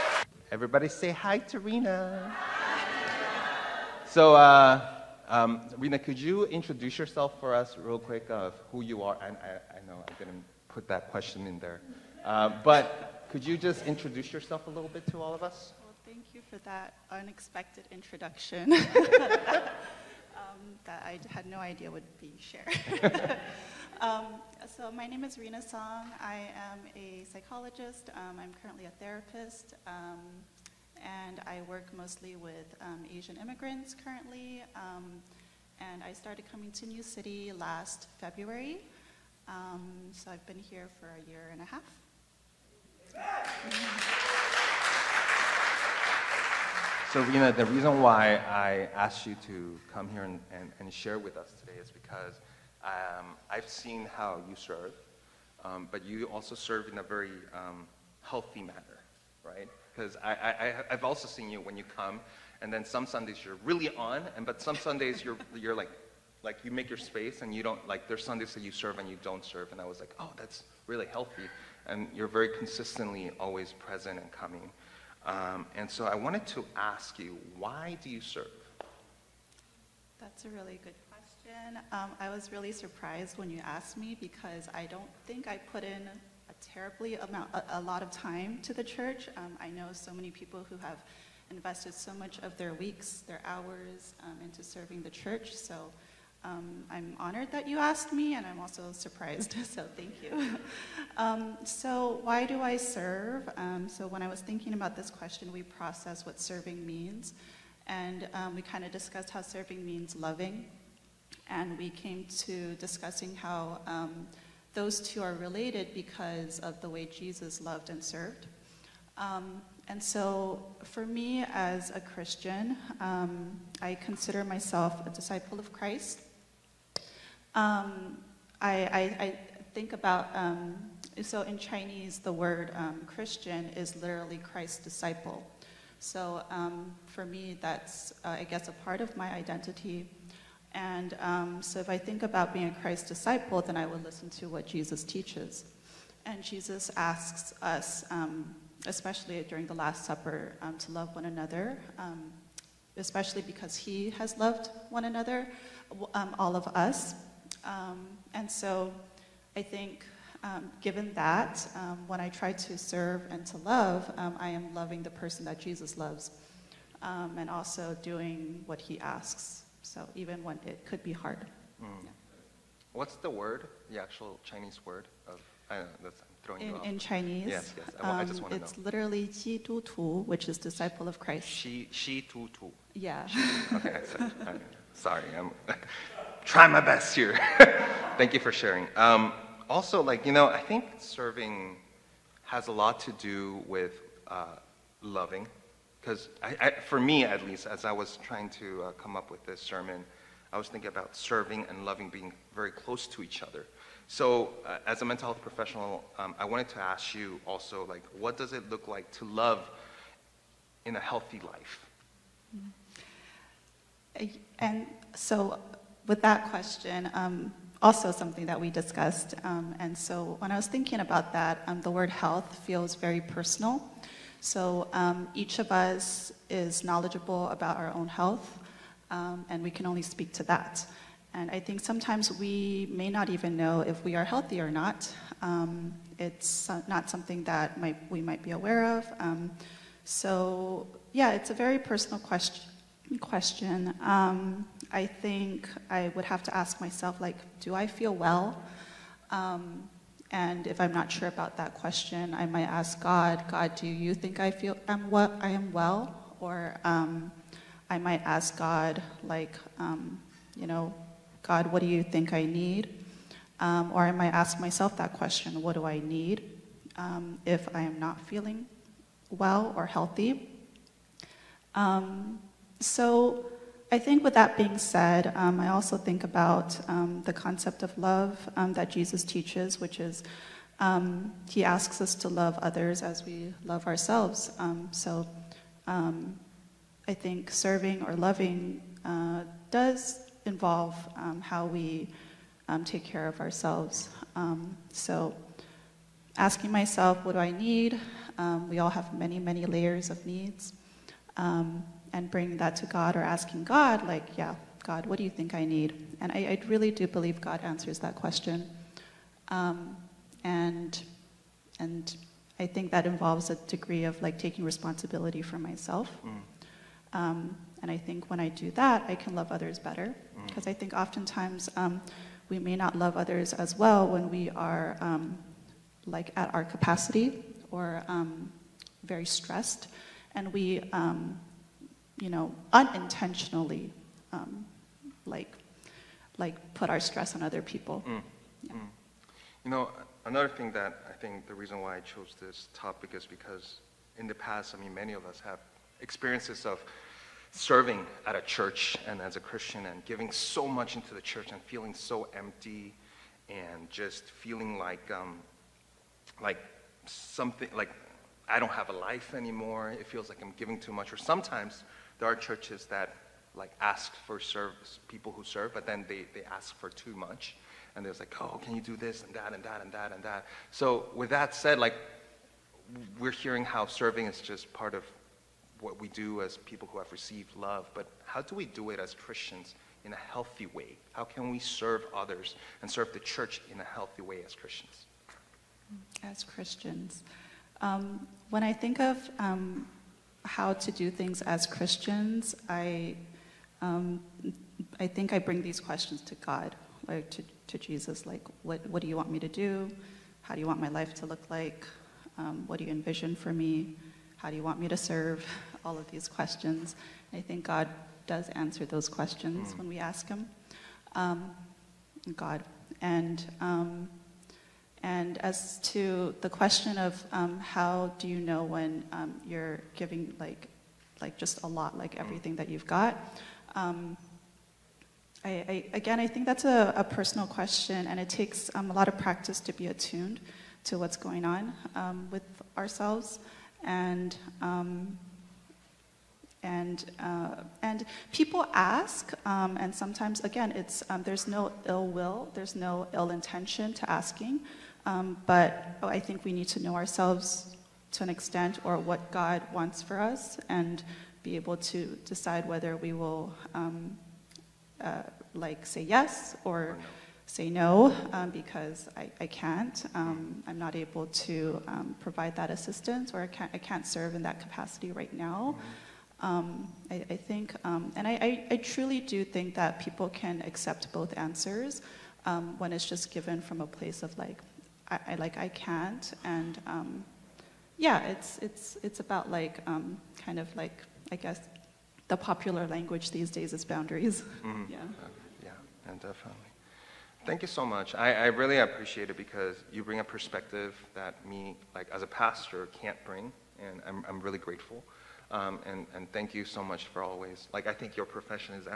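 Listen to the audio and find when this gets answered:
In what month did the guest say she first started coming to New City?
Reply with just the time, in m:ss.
0:38.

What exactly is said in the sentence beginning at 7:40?
Um, I'm not able to um, provide that assistance or I can't, I can't serve in that capacity right now.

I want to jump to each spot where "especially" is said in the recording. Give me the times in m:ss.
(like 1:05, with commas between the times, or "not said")
2:28, 2:32.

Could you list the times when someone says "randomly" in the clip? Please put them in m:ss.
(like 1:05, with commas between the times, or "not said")
not said.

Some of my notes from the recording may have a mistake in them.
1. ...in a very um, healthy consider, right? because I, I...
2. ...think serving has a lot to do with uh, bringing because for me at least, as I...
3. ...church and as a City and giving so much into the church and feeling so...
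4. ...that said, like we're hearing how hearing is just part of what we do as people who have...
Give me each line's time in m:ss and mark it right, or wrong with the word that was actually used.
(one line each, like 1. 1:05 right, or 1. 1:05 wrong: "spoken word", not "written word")
1. 0:56 wrong: "manner", not "consider"
2. 3:10 wrong: "loving", not "bringing"
3. 5:48 wrong: "Christian", not "City"
4. 6:11 wrong: "serving", not "hearing".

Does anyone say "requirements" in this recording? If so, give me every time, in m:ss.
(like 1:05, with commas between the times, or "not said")
not said.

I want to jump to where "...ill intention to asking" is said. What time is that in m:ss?
7:23.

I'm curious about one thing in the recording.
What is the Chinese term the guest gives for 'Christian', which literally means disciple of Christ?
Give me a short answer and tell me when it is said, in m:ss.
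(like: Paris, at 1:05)
Ji Tu Tu, at 2:59.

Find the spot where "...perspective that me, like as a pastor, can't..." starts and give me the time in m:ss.
8:10.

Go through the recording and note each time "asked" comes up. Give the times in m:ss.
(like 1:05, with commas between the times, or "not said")
0:48, 1:23, 1:37.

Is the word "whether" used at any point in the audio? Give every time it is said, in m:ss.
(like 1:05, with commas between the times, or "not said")
7:32.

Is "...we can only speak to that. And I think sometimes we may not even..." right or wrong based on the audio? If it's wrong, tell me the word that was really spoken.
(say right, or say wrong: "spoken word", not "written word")
right.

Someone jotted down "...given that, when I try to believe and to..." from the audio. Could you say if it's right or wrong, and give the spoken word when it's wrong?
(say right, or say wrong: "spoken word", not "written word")
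wrong: "serve", not "believe".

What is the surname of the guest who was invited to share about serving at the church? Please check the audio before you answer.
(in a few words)
Song.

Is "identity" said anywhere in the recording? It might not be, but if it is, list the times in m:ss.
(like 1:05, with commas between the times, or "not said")
2:19.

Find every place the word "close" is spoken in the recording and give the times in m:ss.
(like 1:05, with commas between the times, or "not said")
3:22.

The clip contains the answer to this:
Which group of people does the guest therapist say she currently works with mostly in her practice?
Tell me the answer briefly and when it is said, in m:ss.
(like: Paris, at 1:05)
Asian immigrants, at 0:33.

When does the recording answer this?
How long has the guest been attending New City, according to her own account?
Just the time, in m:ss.
0:41.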